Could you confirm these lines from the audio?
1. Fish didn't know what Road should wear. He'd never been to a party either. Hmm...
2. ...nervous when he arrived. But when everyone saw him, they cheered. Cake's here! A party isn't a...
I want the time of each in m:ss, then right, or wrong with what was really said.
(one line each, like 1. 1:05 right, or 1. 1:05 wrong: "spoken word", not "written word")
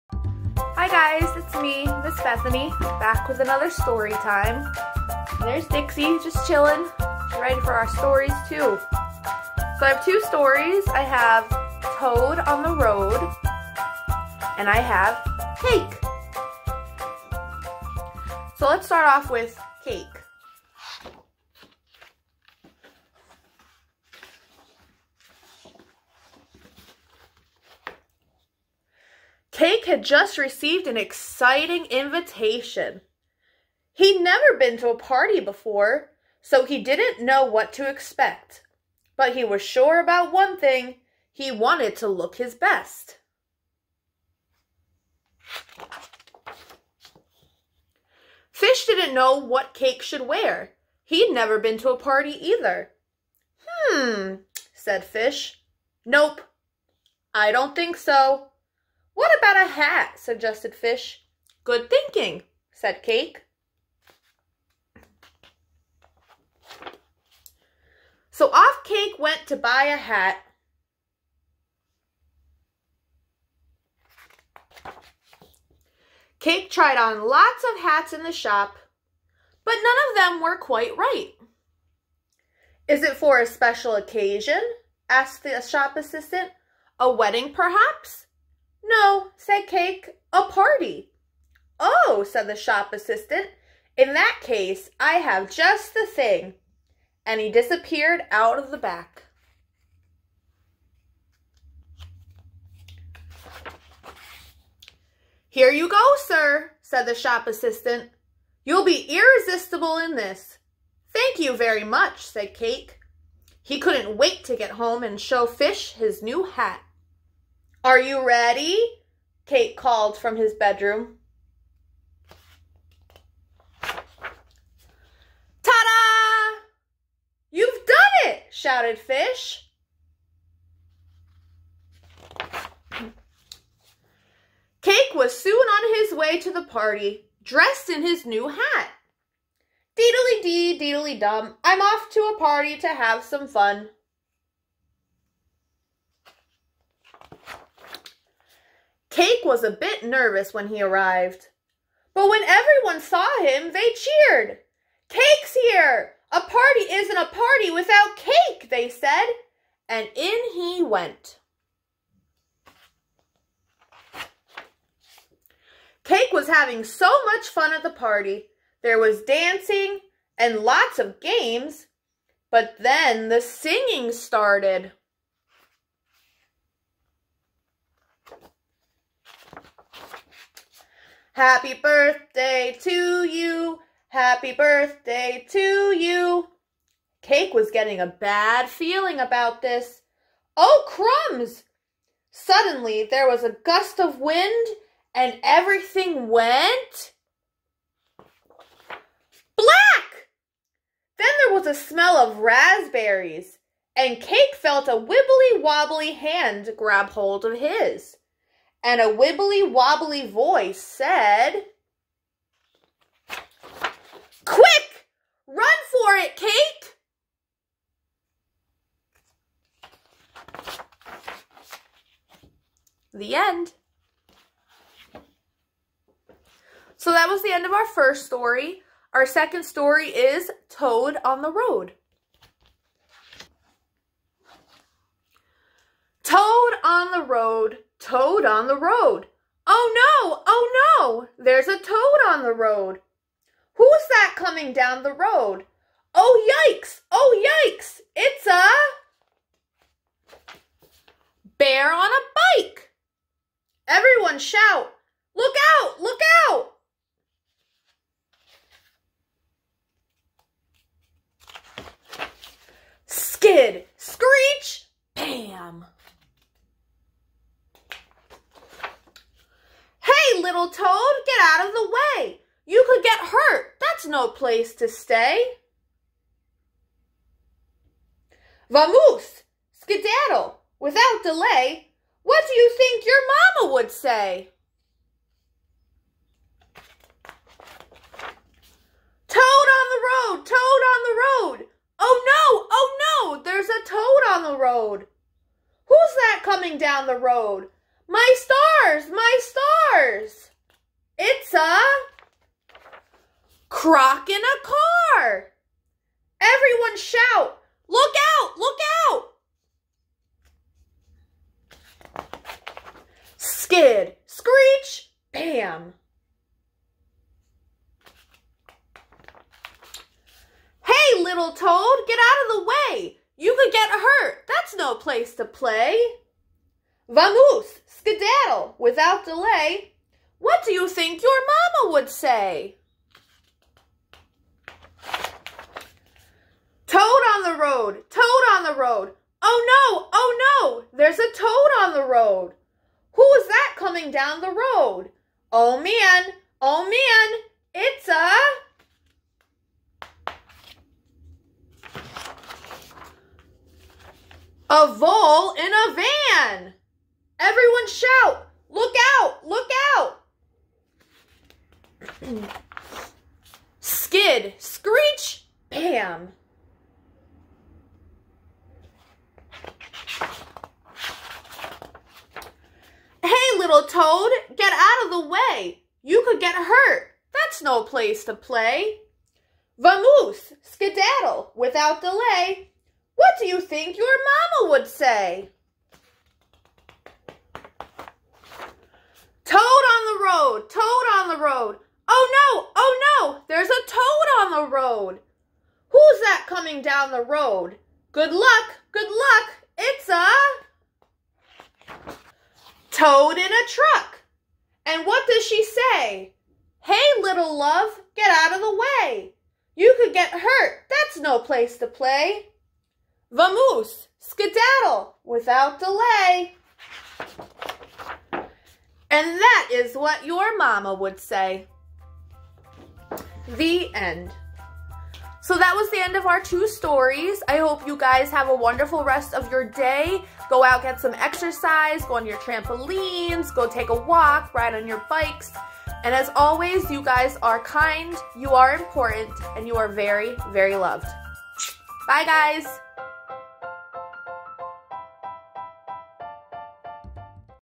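1. 0:48 wrong: "Cake", not "Road"
2. 2:30 right.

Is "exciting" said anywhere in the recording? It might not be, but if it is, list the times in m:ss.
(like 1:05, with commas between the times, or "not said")
0:30.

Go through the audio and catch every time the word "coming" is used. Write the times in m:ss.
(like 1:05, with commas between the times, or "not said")
4:04, 4:56, 5:43, 6:36.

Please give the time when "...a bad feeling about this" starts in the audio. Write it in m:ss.
3:08.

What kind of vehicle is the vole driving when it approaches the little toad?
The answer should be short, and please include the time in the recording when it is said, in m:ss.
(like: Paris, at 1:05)
A van, at 5:55.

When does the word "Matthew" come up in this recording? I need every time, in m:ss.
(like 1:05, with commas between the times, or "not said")
not said.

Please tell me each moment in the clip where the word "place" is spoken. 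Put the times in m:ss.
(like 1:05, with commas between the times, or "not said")
4:34, 5:24, 6:17, 6:51.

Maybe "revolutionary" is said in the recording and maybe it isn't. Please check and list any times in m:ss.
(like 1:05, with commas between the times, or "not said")
not said.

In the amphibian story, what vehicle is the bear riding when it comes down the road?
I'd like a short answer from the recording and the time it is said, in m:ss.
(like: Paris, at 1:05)
A bike, at 4:12.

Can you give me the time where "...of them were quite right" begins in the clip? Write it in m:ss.
1:20.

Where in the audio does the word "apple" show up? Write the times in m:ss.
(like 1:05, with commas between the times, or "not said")
not said.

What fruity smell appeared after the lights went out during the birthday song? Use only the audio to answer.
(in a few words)
Raspberries.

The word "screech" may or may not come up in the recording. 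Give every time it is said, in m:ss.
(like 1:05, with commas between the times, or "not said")
4:23, 5:14, 6:04.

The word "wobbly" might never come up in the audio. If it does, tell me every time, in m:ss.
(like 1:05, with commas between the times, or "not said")
3:25, 3:29.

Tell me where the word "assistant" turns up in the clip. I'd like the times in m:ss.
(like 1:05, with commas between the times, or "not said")
1:25, 1:32, 1:47.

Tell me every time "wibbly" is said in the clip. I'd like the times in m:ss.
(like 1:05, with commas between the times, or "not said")
3:24, 3:29.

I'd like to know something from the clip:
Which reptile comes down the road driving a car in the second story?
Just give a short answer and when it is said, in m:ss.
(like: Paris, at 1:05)
A croc, at 5:03.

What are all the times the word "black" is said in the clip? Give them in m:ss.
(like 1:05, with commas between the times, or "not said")
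3:19.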